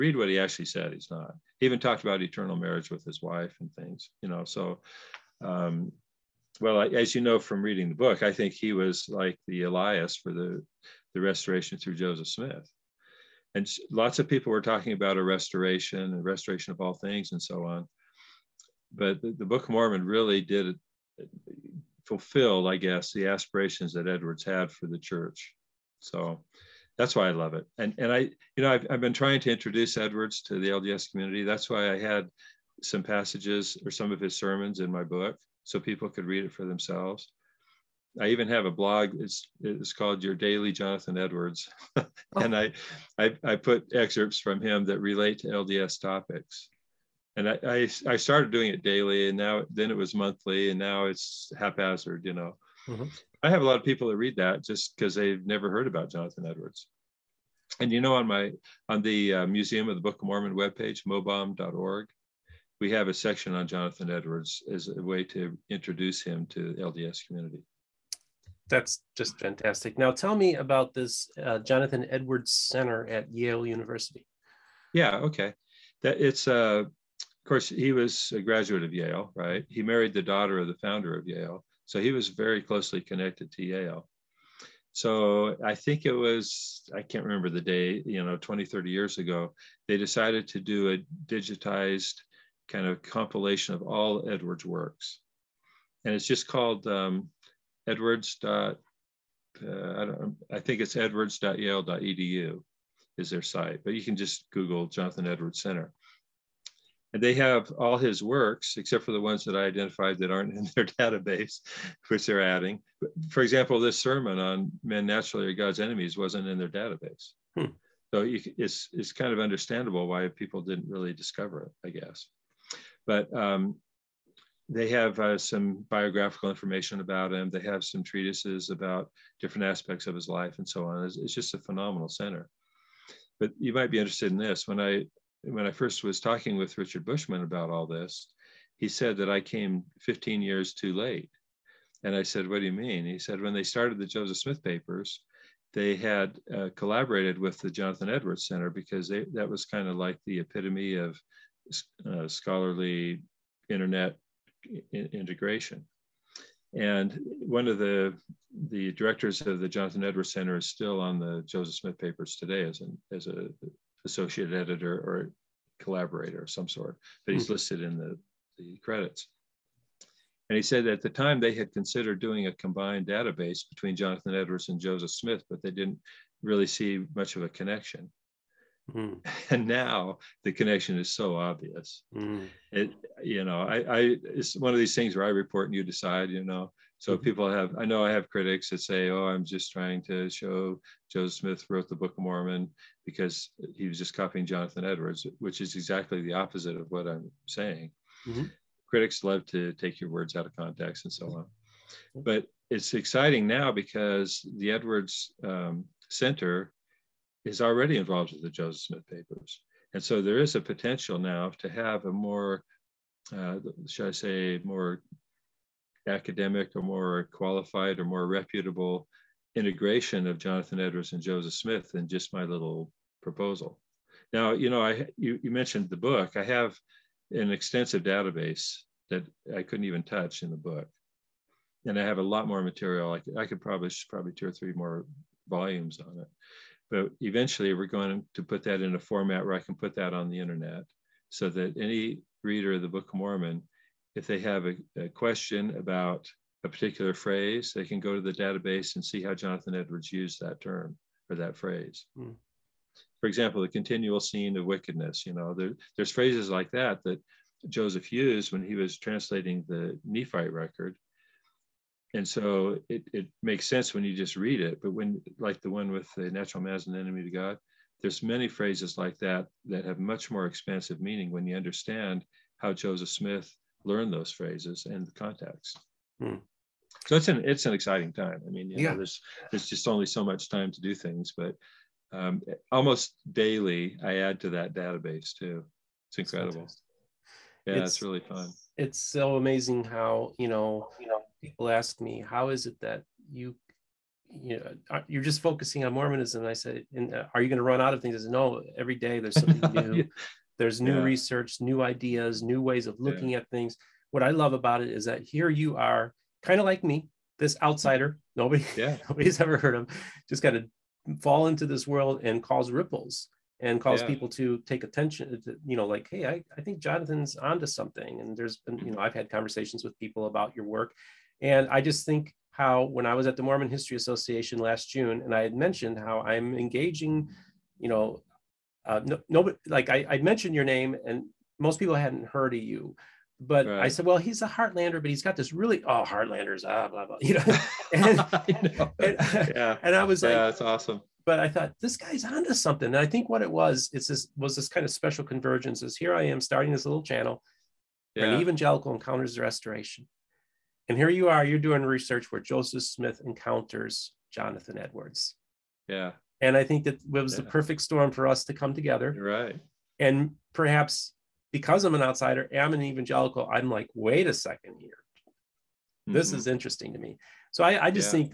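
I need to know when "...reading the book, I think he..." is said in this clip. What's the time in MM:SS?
00:07.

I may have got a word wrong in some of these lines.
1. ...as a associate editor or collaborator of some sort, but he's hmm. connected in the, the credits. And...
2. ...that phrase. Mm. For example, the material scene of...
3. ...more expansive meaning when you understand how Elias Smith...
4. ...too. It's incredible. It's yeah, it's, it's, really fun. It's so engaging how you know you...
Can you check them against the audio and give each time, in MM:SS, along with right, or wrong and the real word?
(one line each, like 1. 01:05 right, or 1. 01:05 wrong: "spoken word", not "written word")
1. 02:43 wrong: "listed", not "connected"
2. 04:11 wrong: "continual", not "material"
3. 04:30 wrong: "Joseph", not "Elias"
4. 04:45 wrong: "amazing", not "engaging".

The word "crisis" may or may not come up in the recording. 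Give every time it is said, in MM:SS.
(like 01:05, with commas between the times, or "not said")
not said.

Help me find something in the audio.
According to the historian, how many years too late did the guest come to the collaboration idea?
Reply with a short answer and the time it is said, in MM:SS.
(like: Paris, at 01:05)
15, at 02:20.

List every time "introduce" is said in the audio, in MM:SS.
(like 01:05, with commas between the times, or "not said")
00:29, 01:05.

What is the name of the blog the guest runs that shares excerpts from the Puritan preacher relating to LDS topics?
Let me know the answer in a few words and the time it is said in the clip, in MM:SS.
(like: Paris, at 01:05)
Your Daily Jonathan Edwards, at 00:40.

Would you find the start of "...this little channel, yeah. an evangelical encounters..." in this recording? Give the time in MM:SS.
05:46.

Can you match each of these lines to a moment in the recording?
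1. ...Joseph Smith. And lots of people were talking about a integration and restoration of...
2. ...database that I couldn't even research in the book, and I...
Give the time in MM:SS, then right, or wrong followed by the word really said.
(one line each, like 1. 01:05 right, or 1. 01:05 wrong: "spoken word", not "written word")
1. 00:11 wrong: "restoration", not "integration"
2. 03:48 wrong: "touch", not "research".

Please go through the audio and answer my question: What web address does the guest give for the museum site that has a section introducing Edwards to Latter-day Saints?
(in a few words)
mobom.org.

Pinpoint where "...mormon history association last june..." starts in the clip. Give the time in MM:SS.
05:23.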